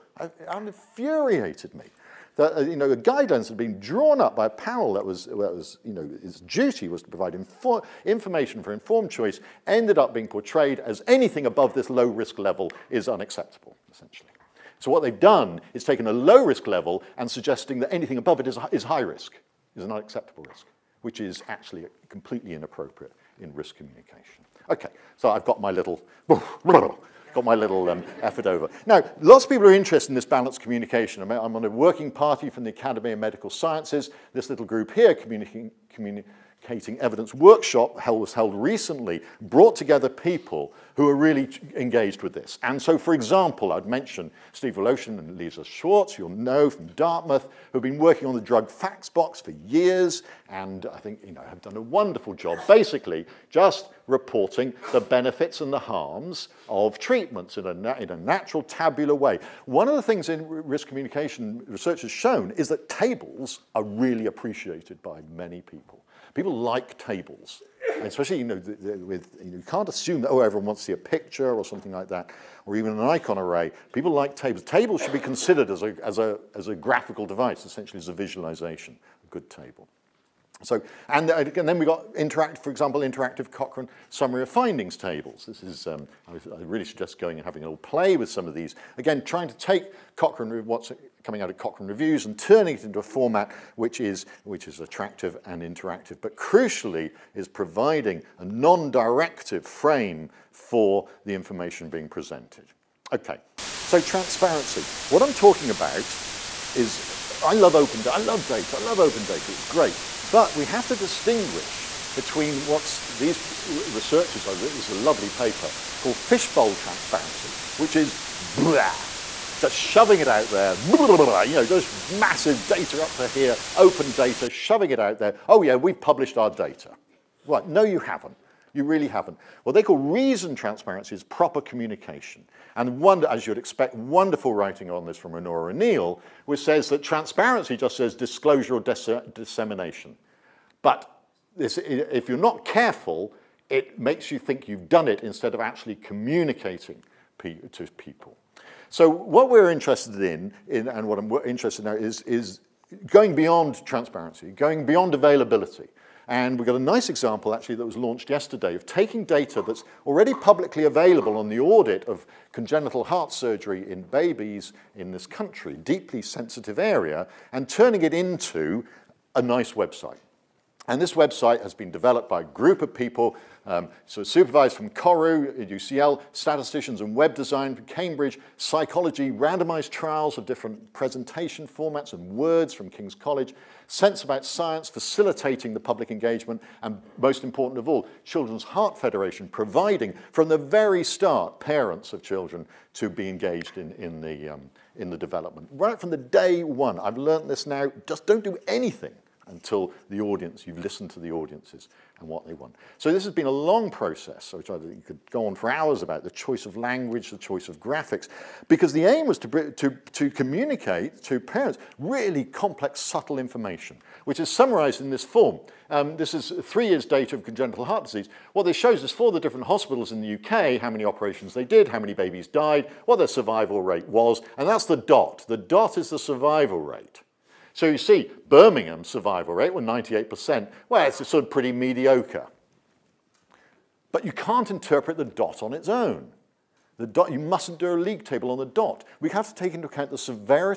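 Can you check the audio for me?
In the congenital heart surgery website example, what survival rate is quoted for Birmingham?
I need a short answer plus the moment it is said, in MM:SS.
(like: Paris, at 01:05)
98%, at 03:49.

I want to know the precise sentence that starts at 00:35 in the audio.
communi Communicating Evidence workshop was held recently, brought together people who are really engaged with this.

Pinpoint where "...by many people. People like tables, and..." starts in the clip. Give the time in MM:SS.
01:05.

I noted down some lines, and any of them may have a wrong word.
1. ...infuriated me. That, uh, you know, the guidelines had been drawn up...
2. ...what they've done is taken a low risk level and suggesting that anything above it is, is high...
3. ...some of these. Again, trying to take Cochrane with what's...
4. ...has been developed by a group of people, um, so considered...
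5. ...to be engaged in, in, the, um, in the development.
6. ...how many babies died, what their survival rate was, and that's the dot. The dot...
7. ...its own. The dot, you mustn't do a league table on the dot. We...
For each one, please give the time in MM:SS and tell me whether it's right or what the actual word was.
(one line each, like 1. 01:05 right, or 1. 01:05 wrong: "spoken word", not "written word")
1. 00:00 right
2. 00:14 right
3. 01:28 right
4. 02:51 wrong: "supervised", not "considered"
5. 03:12 right
6. 03:41 right
7. 03:55 right.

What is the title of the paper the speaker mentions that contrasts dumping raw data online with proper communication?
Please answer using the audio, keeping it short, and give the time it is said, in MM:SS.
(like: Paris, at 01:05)
Fishbowl Transparency, at 01:56.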